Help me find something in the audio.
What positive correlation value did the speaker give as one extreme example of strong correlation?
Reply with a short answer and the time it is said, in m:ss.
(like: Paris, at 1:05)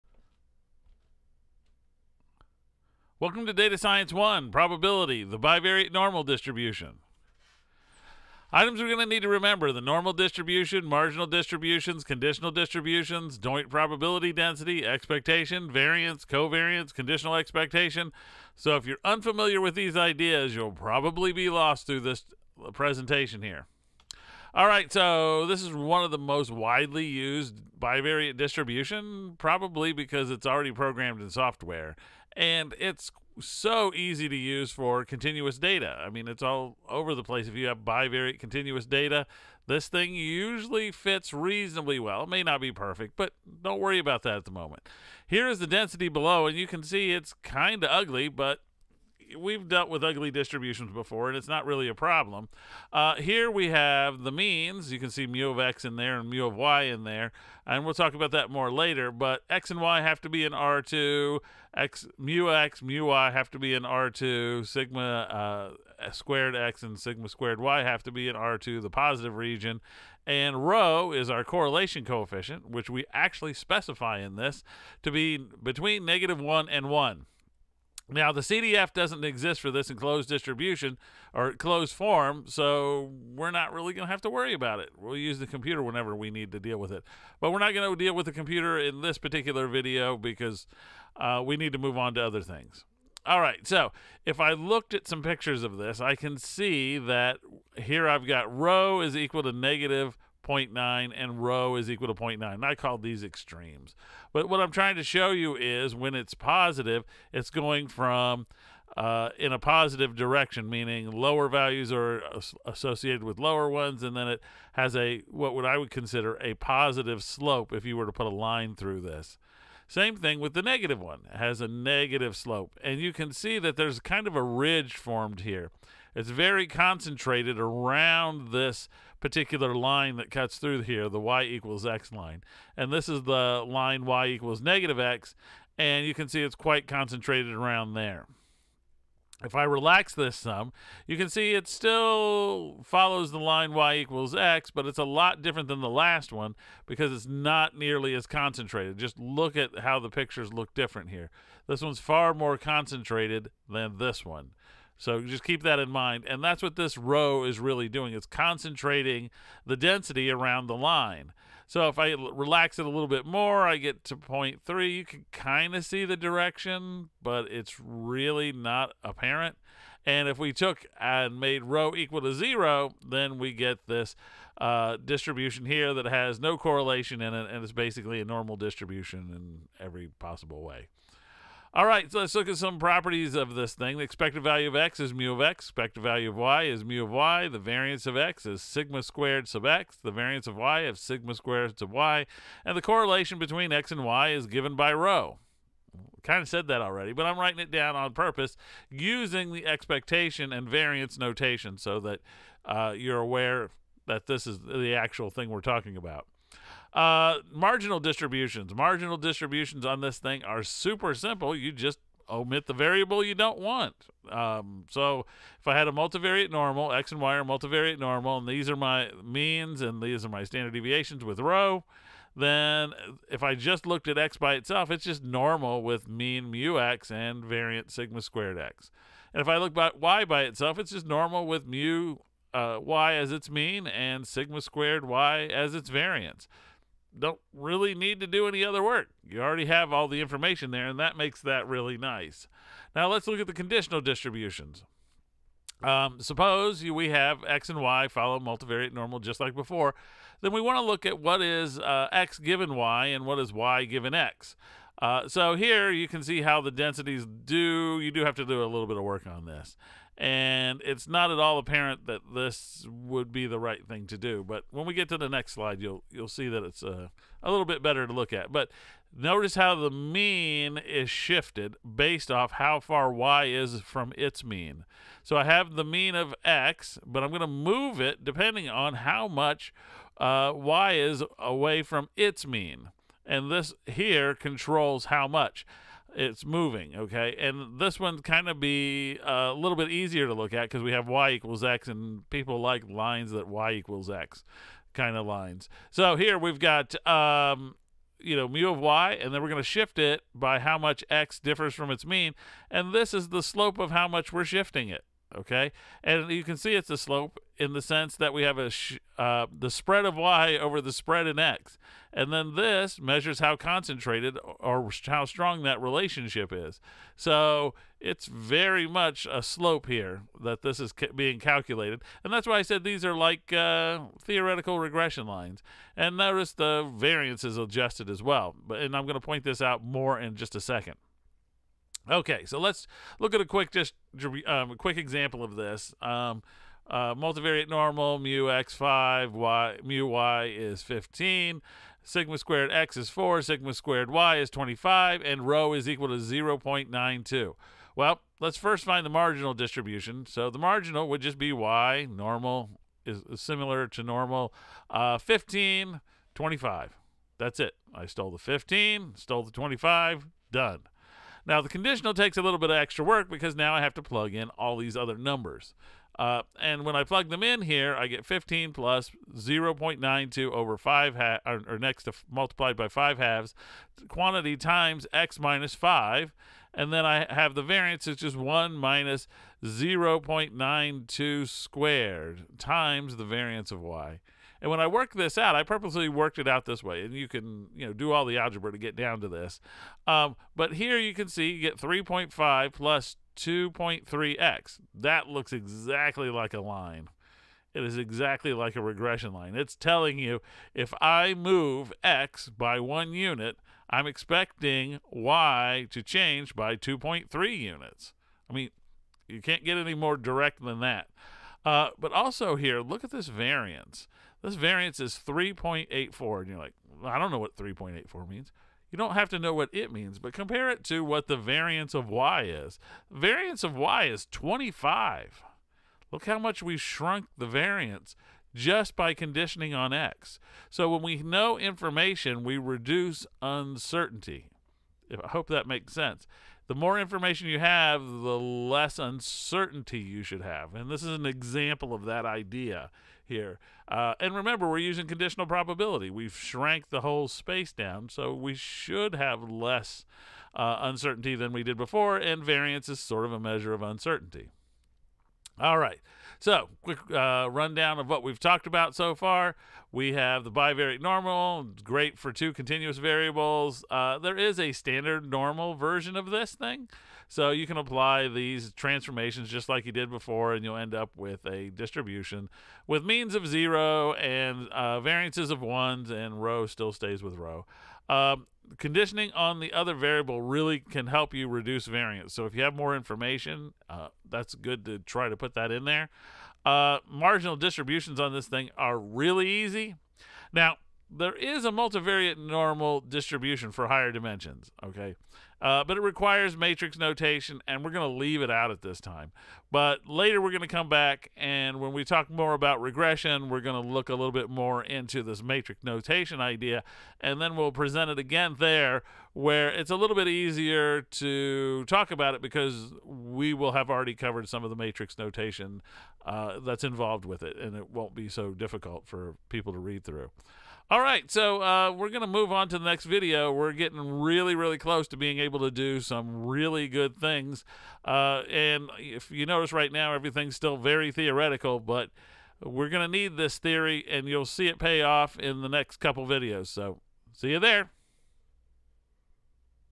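0.9, at 1:41.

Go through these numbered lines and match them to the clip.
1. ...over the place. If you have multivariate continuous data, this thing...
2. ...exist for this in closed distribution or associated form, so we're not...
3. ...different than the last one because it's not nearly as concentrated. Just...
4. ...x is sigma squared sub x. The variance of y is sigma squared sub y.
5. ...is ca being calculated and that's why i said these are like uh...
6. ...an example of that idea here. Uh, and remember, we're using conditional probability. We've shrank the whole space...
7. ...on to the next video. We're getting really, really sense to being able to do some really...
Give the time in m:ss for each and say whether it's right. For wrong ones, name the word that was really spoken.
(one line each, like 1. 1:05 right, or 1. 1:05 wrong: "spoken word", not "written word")
1. 0:36 wrong: "bivariate", not "multivariate"
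2. 1:19 wrong: "closed", not "associated"
3. 2:25 right
4. 3:08 right
5. 5:20 right
6. 7:21 right
7. 8:42 wrong: "close", not "sense".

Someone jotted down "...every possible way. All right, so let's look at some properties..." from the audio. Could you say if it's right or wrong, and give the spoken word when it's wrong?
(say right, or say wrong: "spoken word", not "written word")
right.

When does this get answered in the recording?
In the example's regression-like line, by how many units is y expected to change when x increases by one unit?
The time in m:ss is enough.
6:46.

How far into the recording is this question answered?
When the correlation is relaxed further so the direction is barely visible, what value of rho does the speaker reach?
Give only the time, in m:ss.
2:44.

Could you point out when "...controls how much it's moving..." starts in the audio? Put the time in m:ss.
4:44.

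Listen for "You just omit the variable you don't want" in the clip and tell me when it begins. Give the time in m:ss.
3:31.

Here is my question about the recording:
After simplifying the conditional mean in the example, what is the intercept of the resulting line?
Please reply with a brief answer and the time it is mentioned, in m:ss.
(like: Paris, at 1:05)
3.5, at 6:31.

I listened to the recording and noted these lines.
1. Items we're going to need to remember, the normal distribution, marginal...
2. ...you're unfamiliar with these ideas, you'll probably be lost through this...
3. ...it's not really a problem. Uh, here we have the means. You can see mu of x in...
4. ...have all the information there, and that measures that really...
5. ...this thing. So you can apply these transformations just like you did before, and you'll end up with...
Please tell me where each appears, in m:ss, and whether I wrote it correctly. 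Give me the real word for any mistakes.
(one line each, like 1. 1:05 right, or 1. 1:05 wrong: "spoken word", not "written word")
1. 0:08 right
2. 0:18 right
3. 0:51 right
4. 3:59 wrong: "makes", not "measures"
5. 7:46 right.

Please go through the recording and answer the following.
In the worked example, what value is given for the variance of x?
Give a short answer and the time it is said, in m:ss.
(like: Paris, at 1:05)
4, at 5:42.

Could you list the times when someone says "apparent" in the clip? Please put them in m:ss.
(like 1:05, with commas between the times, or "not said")
2:49, 4:21.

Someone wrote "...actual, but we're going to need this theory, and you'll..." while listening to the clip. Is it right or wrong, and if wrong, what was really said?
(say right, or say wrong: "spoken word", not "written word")
wrong: "theoretical", not "actual".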